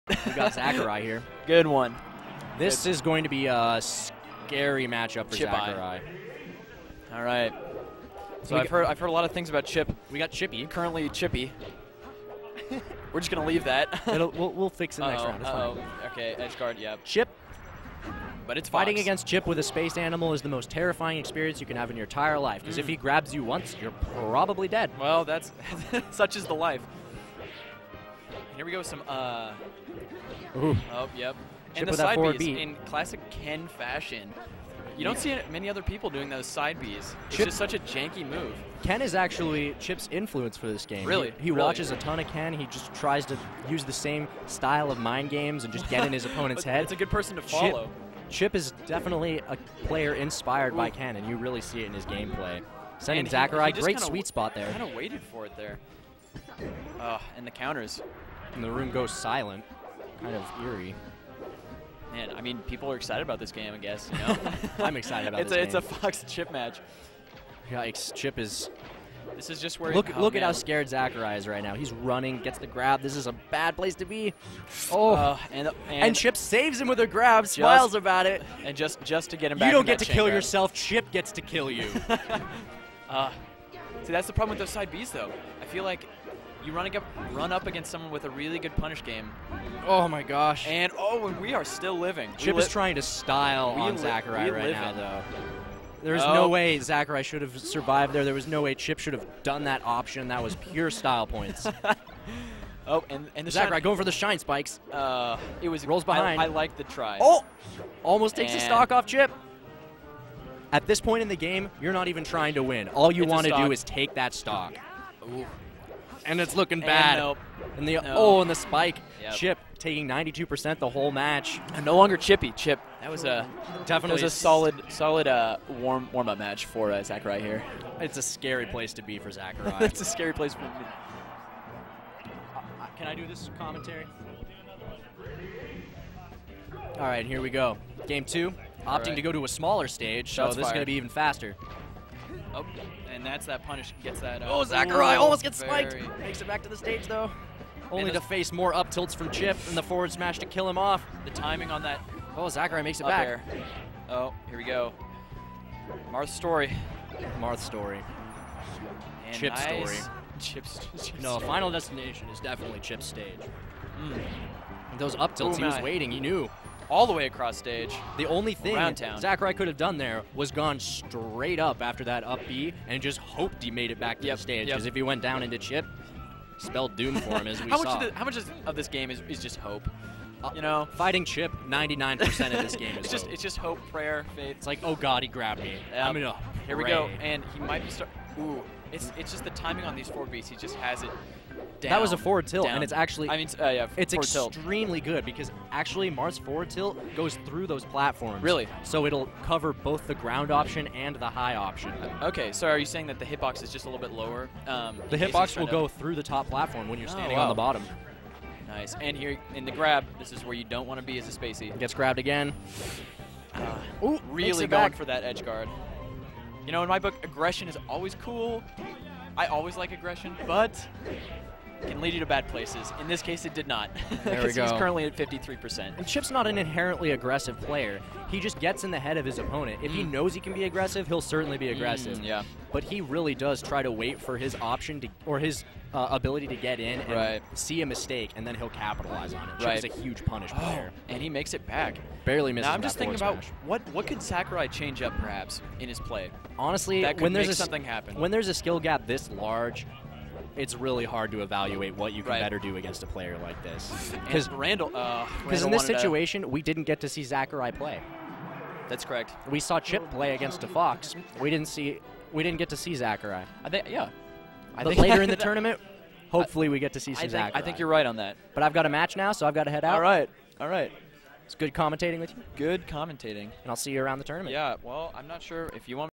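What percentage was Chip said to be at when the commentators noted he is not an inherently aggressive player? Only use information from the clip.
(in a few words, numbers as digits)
53%.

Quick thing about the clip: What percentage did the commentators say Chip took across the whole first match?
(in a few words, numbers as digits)
92%.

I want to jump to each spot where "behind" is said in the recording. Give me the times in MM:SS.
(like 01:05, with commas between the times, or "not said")
01:46.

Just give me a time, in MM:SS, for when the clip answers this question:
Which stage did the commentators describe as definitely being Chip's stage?
02:41.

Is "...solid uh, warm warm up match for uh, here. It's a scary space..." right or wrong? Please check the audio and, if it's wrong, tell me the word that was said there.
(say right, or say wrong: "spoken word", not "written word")
wrong: "place", not "space".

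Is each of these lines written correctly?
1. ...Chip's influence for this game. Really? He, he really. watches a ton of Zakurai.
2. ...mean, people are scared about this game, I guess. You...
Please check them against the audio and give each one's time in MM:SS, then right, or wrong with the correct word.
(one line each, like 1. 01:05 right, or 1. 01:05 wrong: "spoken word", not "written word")
1. 00:39 wrong: "Ken", not "Zakurai"
2. 01:02 wrong: "excited", not "scared".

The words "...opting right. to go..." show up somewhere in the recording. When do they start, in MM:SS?
02:18.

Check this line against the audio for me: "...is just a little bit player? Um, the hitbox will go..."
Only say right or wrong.
wrong.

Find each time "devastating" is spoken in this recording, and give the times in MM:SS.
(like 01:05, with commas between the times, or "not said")
not said.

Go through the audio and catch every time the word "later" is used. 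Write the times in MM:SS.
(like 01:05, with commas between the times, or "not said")
04:24.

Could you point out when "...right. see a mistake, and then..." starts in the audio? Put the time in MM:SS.
03:57.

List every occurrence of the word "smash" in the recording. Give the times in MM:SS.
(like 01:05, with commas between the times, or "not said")
02:30, 04:03.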